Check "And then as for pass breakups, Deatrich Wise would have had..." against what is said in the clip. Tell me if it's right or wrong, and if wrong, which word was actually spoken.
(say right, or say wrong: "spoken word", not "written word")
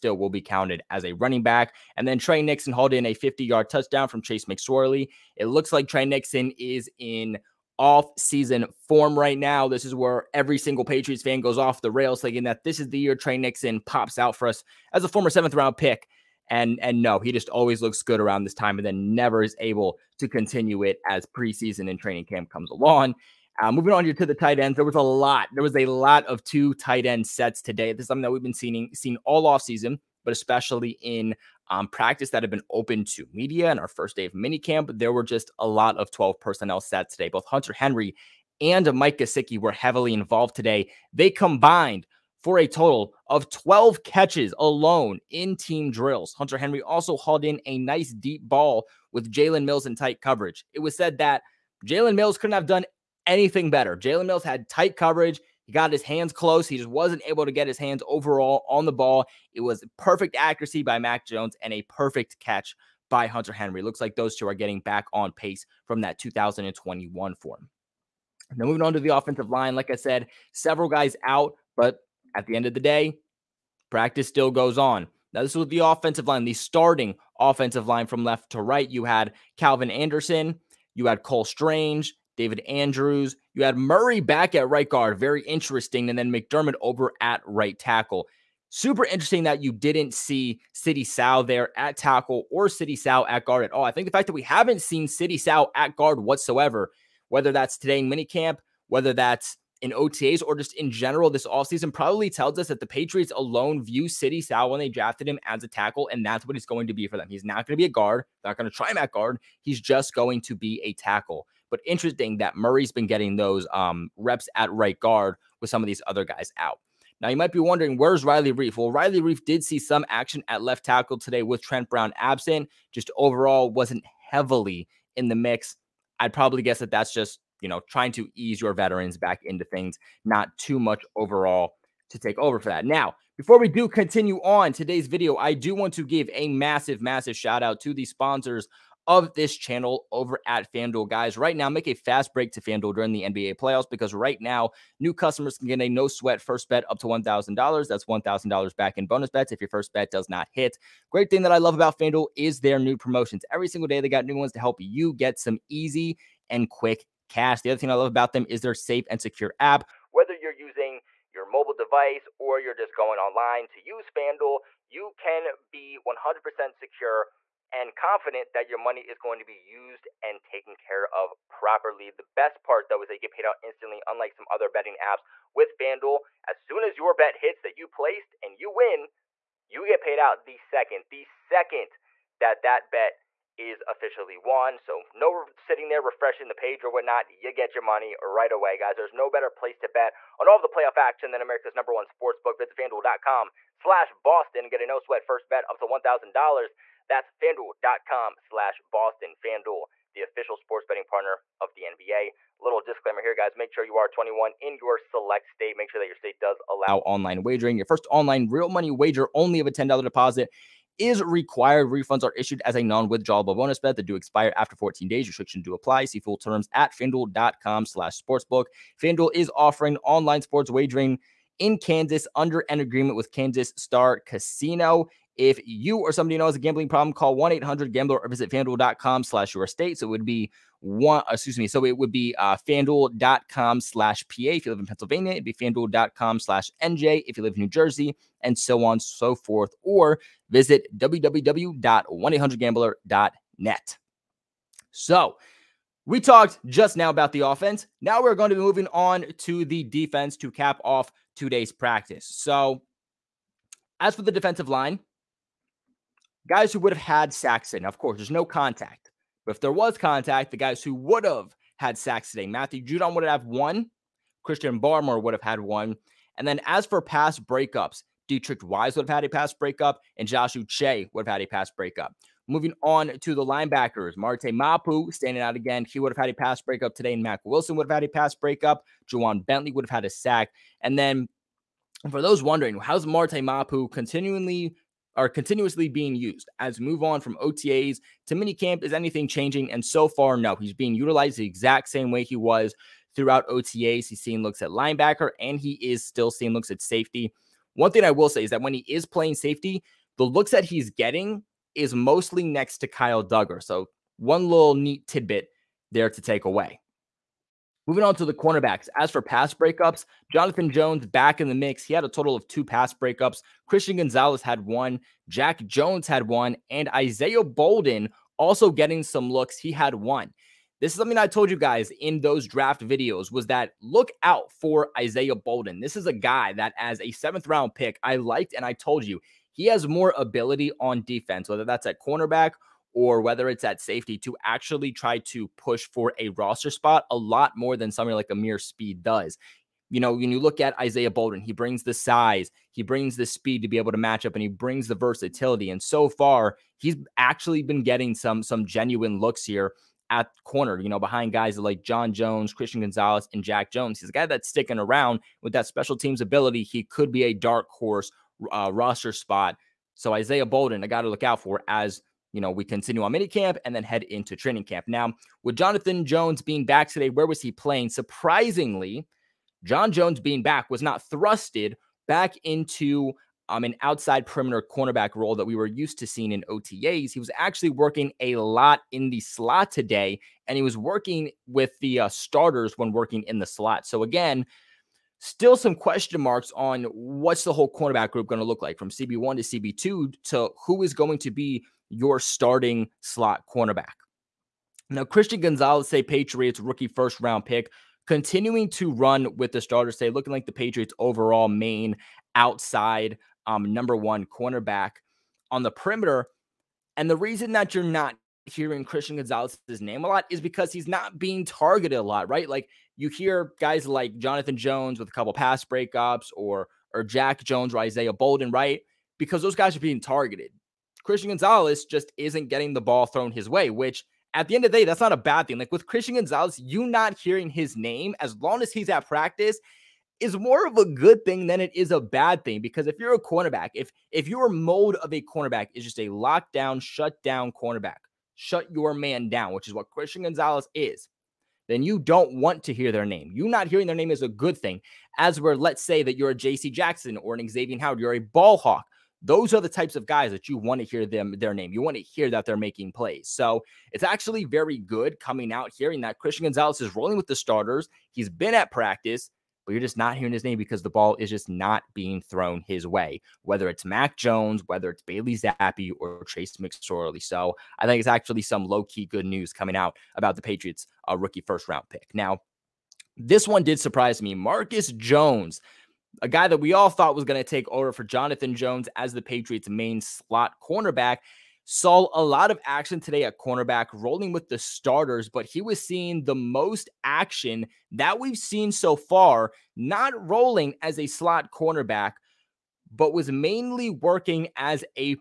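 right.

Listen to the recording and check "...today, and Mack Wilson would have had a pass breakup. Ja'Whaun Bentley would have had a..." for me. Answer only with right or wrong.
right.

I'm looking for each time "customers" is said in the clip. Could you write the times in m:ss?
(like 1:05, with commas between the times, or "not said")
2:25.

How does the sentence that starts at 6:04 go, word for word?
Now, with Jonathan Jones being back today, where was he playing?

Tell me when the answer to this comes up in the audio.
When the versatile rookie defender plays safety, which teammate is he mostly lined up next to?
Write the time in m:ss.
5:02.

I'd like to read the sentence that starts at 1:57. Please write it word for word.
Now, you might be wondering, where's Riley Reiff?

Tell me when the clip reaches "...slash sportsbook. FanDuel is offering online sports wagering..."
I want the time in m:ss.
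3:37.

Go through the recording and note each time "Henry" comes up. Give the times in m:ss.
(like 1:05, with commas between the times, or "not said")
0:37, 0:46, 1:03.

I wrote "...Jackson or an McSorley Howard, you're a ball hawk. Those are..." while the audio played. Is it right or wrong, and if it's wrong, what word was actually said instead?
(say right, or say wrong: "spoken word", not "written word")
wrong: "Xavier", not "McSorley".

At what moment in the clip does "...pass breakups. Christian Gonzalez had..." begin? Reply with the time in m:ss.
5:12.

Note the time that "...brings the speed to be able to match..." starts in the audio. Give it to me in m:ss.
5:42.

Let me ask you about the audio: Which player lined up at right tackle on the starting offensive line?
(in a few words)
McDermott.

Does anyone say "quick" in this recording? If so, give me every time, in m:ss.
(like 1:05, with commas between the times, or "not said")
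2:36.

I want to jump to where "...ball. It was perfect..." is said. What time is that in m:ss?
0:58.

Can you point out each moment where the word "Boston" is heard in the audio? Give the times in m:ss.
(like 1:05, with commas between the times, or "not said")
3:14, 3:18.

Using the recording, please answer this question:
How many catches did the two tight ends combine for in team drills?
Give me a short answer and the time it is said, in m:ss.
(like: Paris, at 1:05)
12, at 0:43.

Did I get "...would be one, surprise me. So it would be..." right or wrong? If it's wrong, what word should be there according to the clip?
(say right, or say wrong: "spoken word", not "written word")
wrong: "excuse", not "surprise".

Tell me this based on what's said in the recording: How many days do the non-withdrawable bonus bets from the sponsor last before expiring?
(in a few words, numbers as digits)
14.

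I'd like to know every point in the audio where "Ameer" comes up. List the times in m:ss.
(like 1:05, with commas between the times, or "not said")
5:38.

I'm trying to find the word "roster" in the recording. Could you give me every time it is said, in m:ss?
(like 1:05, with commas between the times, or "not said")
5:36, 5:58.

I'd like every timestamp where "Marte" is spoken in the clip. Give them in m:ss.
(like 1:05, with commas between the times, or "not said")
4:34, 4:43.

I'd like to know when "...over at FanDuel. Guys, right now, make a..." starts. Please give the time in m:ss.
2:20.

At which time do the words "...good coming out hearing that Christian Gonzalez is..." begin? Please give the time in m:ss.
7:34.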